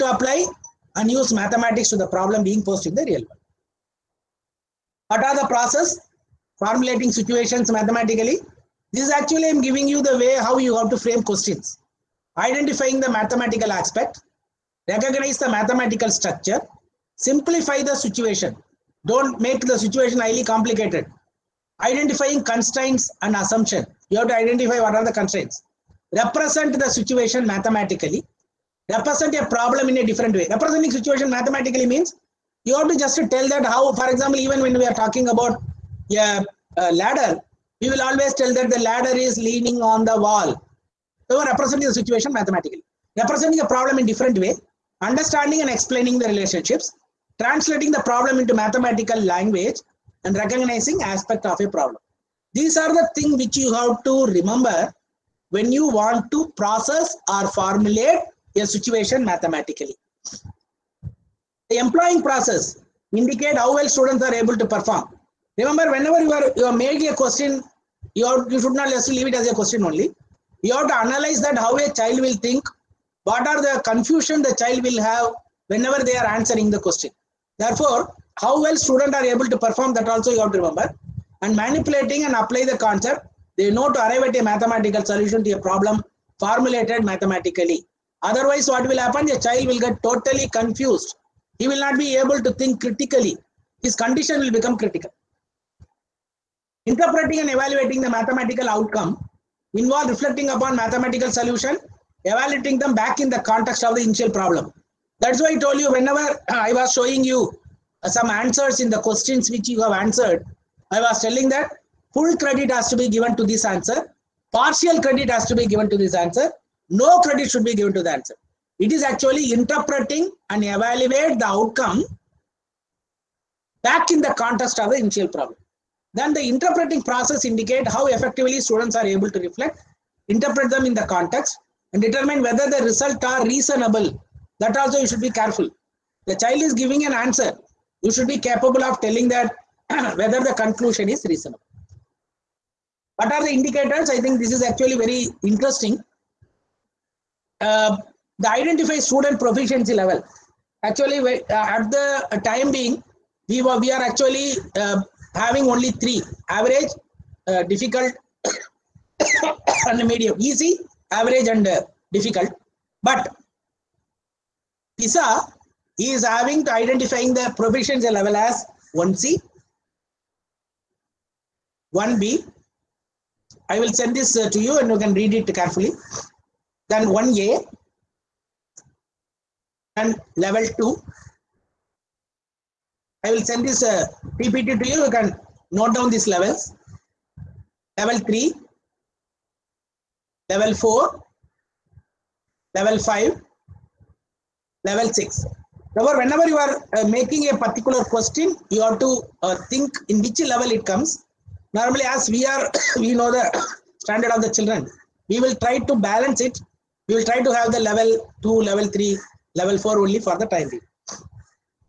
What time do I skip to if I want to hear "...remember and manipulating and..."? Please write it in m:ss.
1:20.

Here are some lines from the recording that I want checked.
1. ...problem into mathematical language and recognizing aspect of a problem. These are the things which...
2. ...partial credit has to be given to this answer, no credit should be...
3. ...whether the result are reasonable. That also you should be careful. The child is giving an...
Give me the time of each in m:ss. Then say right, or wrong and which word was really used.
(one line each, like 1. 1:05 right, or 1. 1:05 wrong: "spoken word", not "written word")
1. 0:48 right
2. 1:54 right
3. 2:12 right.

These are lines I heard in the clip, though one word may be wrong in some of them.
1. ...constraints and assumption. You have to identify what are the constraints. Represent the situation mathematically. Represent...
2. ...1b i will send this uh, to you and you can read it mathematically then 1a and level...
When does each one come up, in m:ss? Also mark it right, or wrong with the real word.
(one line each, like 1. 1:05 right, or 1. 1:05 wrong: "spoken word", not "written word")
1. 0:22 right
2. 2:52 wrong: "carefully", not "mathematically".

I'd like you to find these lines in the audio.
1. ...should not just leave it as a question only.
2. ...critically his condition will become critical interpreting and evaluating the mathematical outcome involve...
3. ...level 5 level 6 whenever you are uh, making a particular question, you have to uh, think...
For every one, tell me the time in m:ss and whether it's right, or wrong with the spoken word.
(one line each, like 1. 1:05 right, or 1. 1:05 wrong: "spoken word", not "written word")
1. 1:08 right
2. 1:32 right
3. 3:12 right.